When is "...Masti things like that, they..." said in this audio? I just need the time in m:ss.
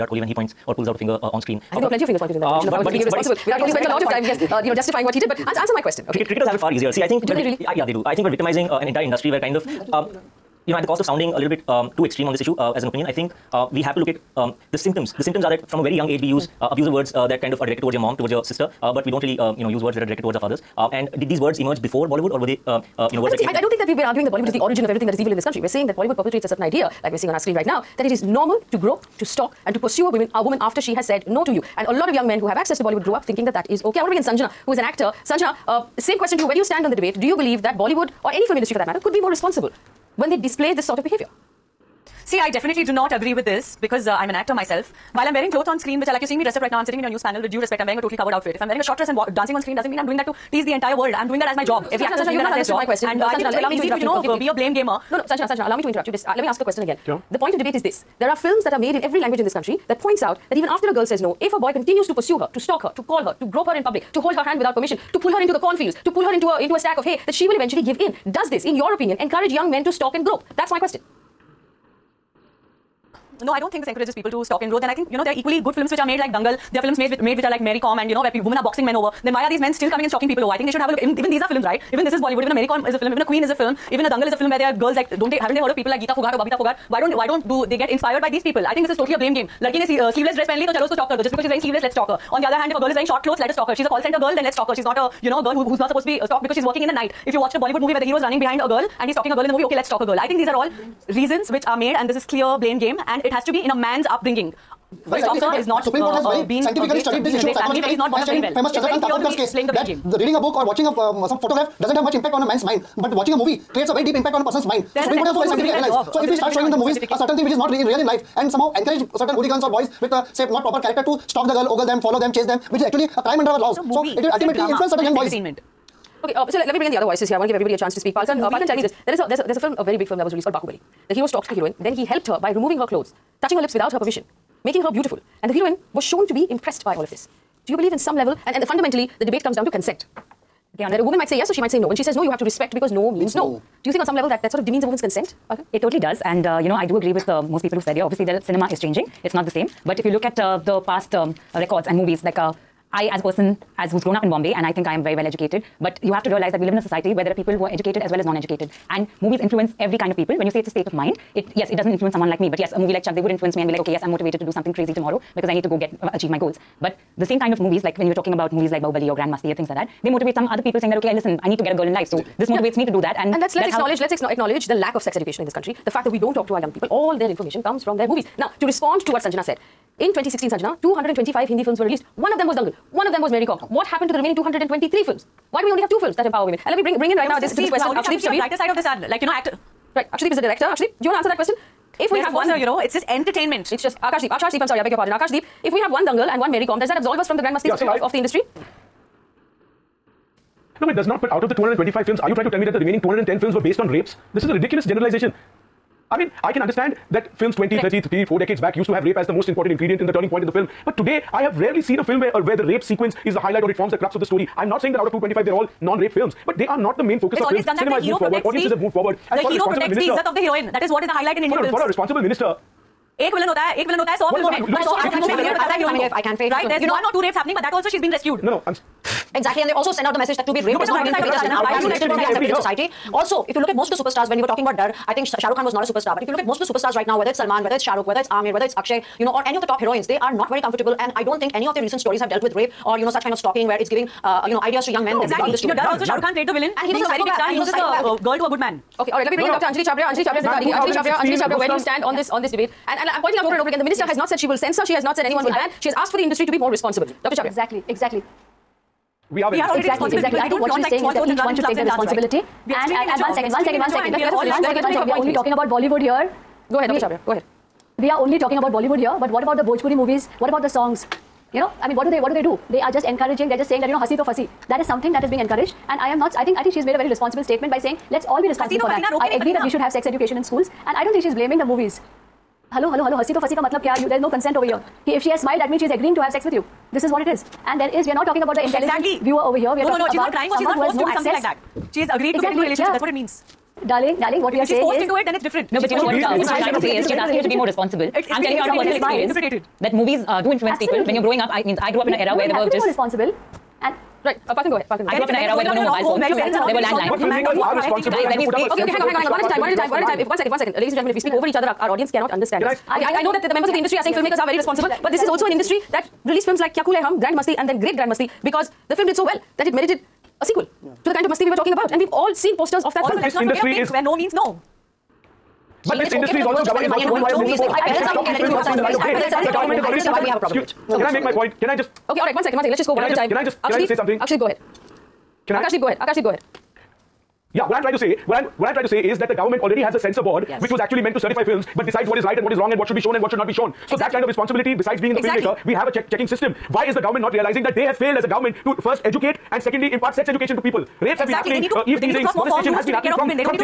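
2:49.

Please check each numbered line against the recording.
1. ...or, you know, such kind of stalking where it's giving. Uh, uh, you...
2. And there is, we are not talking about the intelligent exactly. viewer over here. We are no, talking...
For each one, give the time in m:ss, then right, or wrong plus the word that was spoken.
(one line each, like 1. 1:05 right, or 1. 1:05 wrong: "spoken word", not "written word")
1. 4:02 right
2. 4:47 right.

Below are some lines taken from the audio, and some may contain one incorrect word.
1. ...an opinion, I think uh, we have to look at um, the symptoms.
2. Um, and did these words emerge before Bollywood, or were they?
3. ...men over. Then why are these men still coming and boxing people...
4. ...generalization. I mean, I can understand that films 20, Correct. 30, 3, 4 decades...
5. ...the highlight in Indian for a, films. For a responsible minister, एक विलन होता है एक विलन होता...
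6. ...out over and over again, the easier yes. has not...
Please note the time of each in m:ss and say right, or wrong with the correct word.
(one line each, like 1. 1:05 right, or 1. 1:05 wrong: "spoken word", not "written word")
1. 0:12 right
2. 0:20 right
3. 1:18 wrong: "stalking", not "boxing"
4. 3:24 right
5. 3:41 right
6. 4:13 wrong: "minister", not "easier".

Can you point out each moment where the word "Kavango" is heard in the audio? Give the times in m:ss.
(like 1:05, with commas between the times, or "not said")
not said.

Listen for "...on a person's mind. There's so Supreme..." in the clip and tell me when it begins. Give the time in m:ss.
1:54.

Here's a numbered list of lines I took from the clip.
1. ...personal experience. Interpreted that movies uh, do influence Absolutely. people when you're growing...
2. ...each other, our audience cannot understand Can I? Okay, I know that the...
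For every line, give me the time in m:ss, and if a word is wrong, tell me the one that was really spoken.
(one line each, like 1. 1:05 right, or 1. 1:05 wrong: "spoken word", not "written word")
1. 4:58 right
2. 5:11 right.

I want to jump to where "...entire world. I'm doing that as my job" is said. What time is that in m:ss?
0:50.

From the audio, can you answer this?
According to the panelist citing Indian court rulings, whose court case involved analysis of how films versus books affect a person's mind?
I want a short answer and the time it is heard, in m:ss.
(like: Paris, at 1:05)
Chandrakant Kakodkar, at 1:48.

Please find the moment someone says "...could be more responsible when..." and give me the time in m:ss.
0:38.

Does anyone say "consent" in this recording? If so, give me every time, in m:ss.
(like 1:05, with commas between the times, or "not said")
2:19, 2:24, 4:44.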